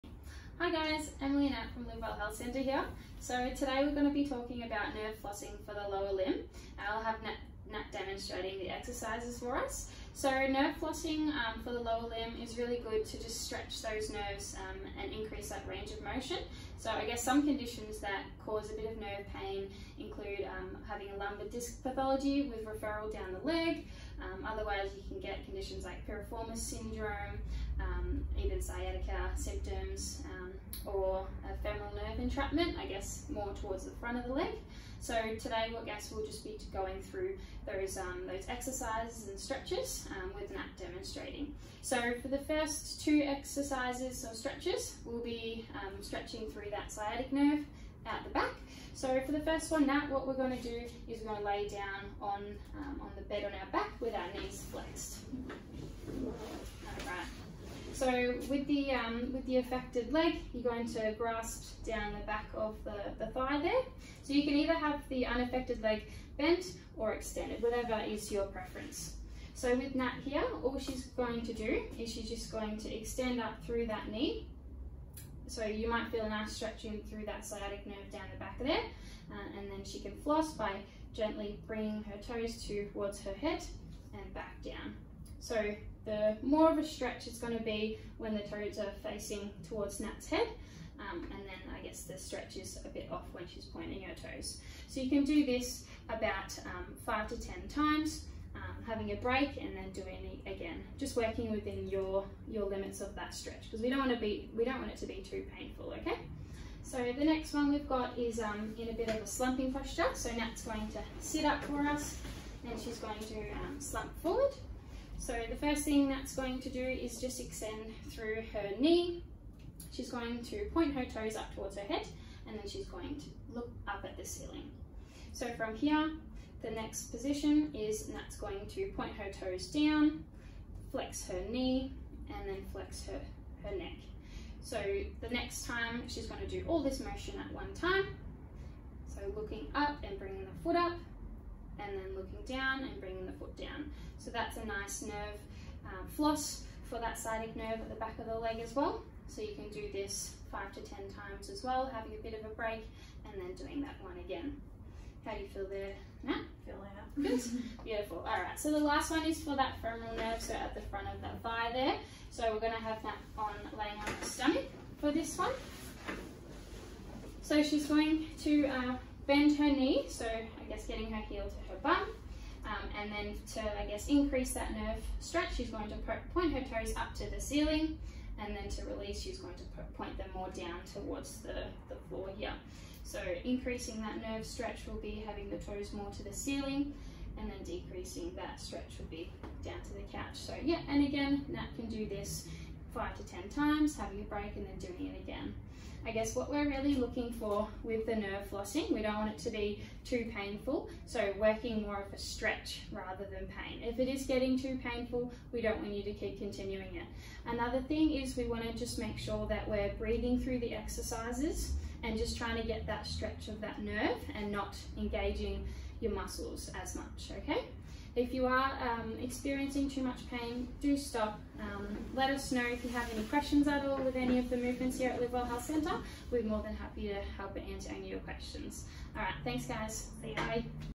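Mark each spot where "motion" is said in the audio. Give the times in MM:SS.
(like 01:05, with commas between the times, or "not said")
00:16, 02:16.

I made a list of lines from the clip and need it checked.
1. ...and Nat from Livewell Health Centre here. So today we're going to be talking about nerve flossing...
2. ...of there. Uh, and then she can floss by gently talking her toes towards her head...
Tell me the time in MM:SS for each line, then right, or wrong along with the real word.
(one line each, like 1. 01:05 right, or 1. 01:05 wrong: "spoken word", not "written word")
1. 00:01 right
2. 01:18 wrong: "bringing", not "talking".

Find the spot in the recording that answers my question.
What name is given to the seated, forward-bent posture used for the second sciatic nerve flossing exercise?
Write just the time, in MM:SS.
01:49.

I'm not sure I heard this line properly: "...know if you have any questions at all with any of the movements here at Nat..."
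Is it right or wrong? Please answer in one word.
wrong.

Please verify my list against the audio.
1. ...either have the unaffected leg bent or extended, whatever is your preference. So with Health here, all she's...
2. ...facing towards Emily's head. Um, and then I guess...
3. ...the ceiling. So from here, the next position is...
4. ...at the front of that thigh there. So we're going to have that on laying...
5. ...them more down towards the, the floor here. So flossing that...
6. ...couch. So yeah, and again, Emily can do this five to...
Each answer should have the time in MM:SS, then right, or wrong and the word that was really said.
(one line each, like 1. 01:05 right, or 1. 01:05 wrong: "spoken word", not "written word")
1. 01:04 wrong: "Nat", not "Health"
2. 01:29 wrong: "Nat", not "Emily"
3. 02:04 right
4. 02:40 right
5. 03:00 wrong: "increasing", not "flossing"
6. 03:10 wrong: "Nat", not "Emily".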